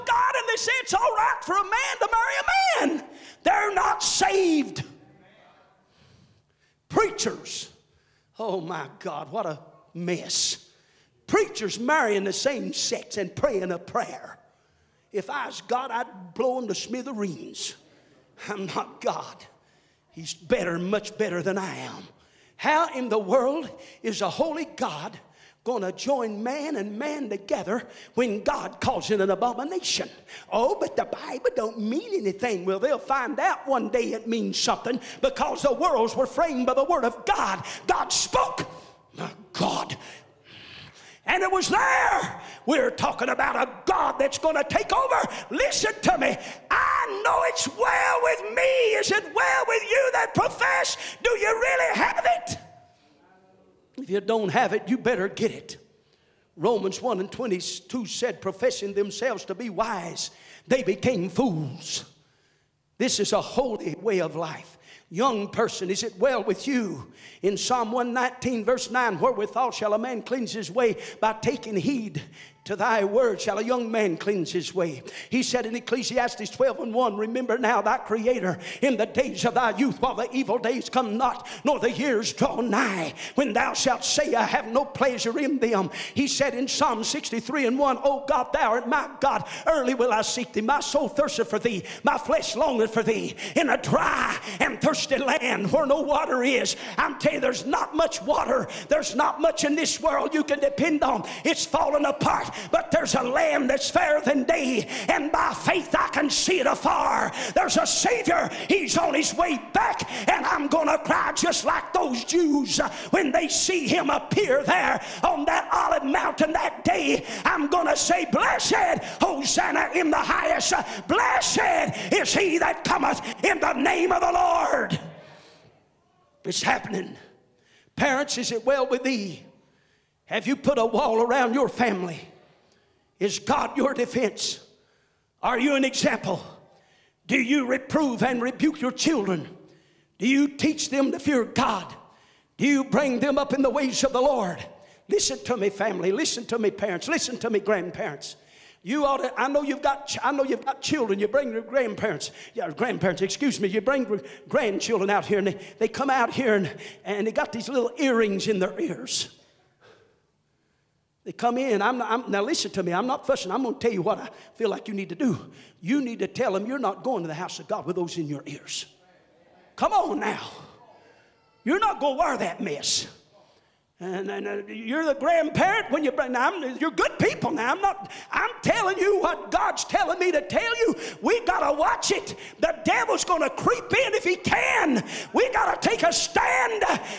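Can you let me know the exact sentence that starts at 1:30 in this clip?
My soul thirsteth for thee, my flesh longeth for thee.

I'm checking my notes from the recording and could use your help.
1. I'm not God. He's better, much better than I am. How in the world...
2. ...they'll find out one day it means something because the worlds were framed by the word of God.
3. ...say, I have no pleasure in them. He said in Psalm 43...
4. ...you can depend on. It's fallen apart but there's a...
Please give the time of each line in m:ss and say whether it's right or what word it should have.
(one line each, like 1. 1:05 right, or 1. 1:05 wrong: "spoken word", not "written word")
1. 0:18 right
2. 0:32 right
3. 1:24 wrong: "63", not "43"
4. 1:40 right.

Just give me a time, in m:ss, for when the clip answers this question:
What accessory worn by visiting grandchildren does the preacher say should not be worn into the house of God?
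2:37.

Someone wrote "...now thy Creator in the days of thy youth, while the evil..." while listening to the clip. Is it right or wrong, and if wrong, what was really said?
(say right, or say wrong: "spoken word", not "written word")
right.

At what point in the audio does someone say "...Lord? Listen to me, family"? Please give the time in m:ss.
2:24.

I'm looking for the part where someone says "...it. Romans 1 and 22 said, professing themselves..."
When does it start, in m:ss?
0:55.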